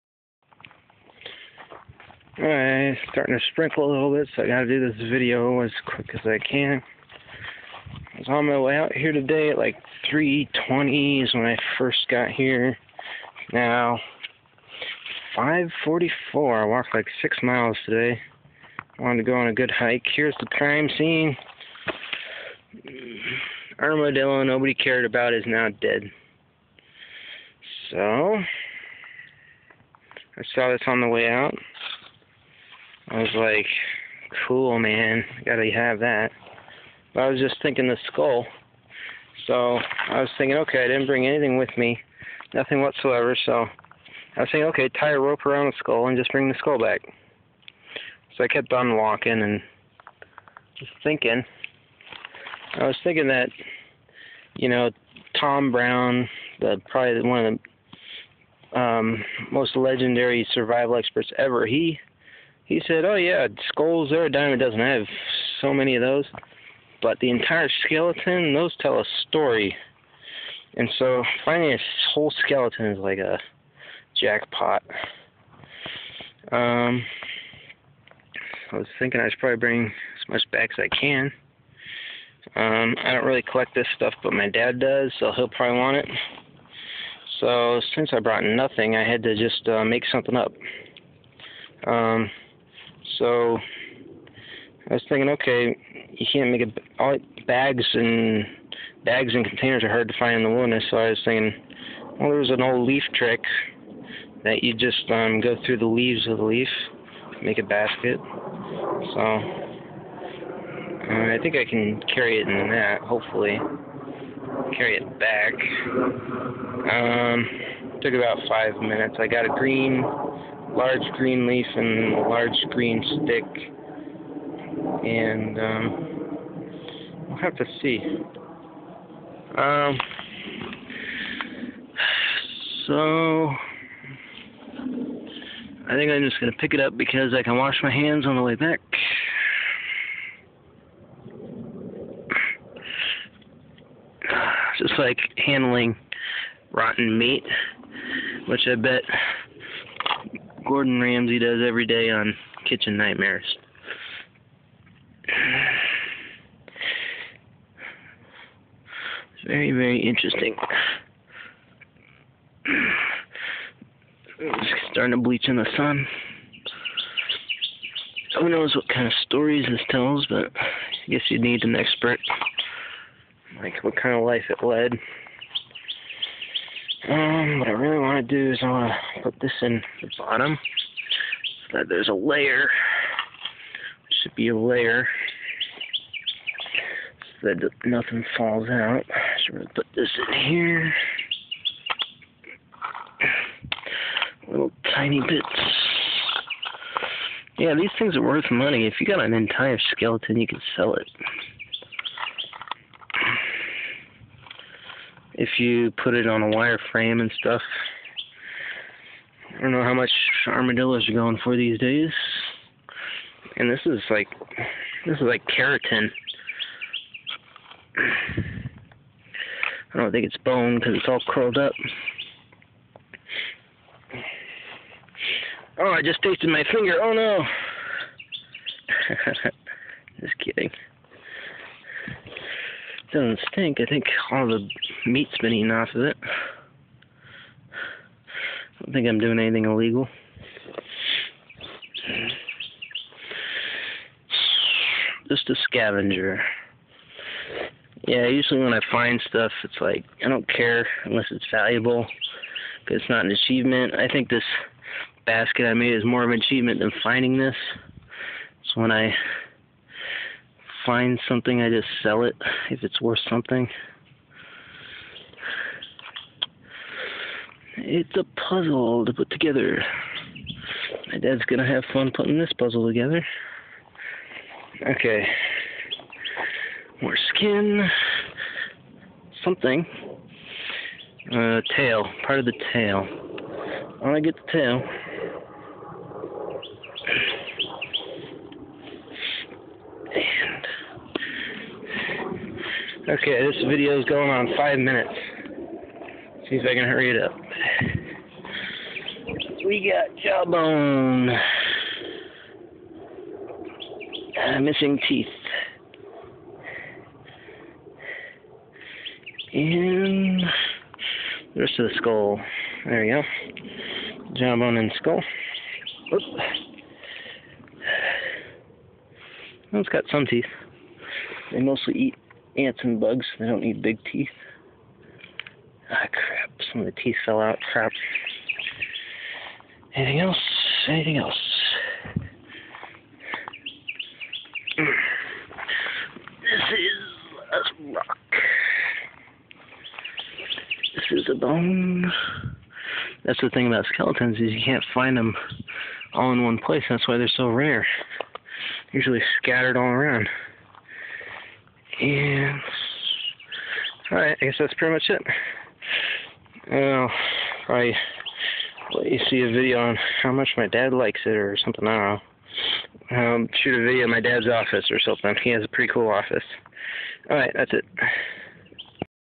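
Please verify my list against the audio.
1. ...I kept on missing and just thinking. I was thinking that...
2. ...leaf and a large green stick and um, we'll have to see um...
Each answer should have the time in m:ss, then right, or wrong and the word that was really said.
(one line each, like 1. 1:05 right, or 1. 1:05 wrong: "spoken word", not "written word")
1. 0:48 wrong: "walking", not "missing"
2. 2:01 right.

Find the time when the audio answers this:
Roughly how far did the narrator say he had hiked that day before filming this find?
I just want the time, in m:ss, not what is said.
0:17.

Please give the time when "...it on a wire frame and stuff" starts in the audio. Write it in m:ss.
3:26.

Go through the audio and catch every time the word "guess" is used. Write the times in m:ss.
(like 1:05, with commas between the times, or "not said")
2:51, 5:54.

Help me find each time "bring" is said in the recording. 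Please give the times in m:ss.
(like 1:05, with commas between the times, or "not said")
0:41, 0:46, 1:19.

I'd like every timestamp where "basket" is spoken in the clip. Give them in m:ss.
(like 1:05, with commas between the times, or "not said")
1:47, 4:15.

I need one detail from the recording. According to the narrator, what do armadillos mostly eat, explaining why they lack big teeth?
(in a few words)
ants and bugs.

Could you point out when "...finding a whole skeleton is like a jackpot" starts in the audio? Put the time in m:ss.
1:11.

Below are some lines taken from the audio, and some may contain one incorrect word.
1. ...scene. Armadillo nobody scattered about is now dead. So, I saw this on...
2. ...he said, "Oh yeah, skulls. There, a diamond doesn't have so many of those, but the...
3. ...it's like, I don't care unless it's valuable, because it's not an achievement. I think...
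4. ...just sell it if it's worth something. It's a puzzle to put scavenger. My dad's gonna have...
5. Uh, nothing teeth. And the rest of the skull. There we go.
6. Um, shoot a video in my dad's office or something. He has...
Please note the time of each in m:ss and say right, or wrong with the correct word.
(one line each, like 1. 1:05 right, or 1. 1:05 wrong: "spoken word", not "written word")
1. 0:20 wrong: "cared", not "scattered"
2. 1:02 right
3. 4:09 right
4. 4:21 wrong: "together", not "scavenger"
5. 5:04 wrong: "missing", not "nothing"
6. 6:03 right.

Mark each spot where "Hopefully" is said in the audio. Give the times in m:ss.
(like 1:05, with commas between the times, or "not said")
1:53.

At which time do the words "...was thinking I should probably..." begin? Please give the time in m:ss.
1:18.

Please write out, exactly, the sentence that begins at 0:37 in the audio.
But I was just thinking the skull.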